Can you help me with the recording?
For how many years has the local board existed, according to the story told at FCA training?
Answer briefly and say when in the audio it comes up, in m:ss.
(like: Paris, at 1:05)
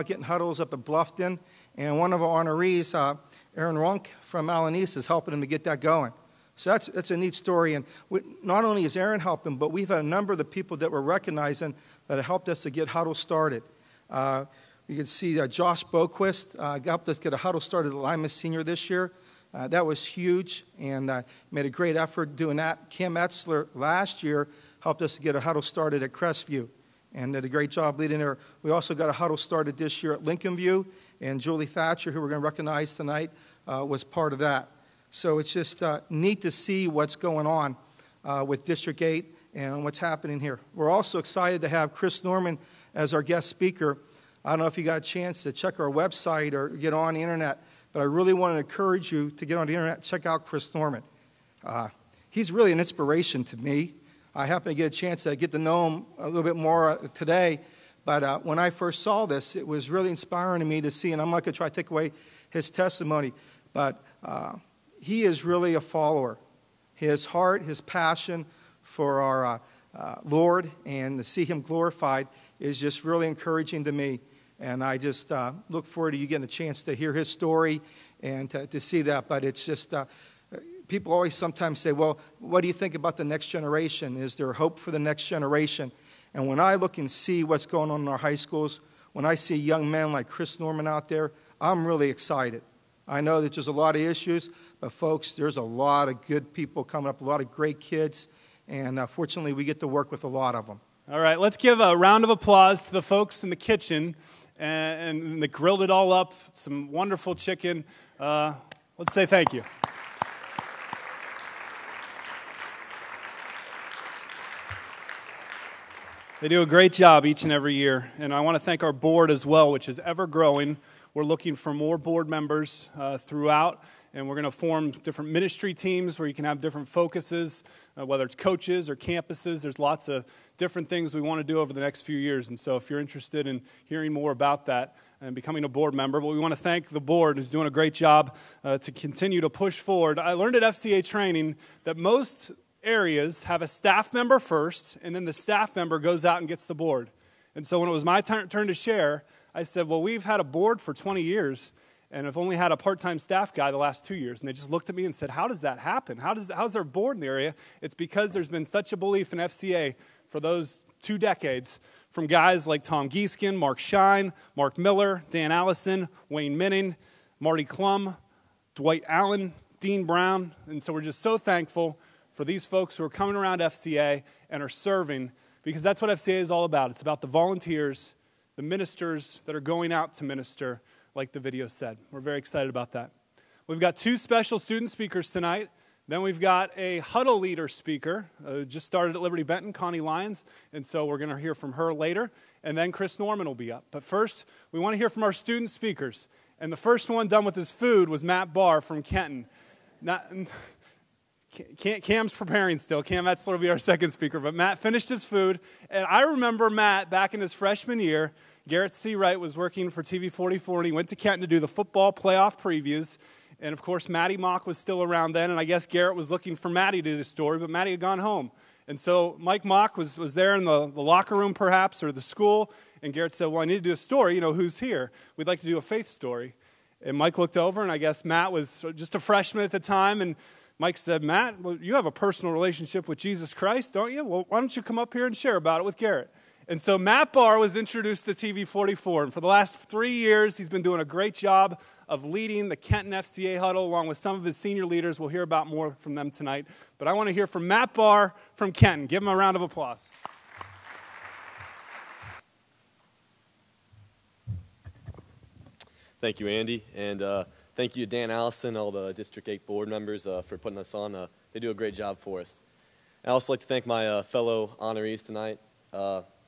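20, at 2:30.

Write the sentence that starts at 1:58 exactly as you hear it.
And I want to thank our board as well, which is ever growing.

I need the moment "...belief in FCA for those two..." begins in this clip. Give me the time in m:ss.
2:38.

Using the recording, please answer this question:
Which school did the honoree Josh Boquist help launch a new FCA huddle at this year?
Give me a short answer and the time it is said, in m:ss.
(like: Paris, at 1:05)
Lima Senior, at 0:17.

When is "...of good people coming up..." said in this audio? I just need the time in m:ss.
1:36.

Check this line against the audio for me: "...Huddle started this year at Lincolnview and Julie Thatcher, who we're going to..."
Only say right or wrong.
right.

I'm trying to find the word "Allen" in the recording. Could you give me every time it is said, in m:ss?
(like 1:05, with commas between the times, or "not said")
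0:04, 2:49.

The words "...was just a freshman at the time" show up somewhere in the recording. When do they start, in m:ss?
3:48.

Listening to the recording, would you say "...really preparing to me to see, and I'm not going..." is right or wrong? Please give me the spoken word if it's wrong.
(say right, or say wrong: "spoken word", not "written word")
wrong: "inspiring", not "preparing".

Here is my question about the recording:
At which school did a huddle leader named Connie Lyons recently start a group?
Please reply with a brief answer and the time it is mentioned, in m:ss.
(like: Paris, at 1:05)
Liberty Benton, at 3:09.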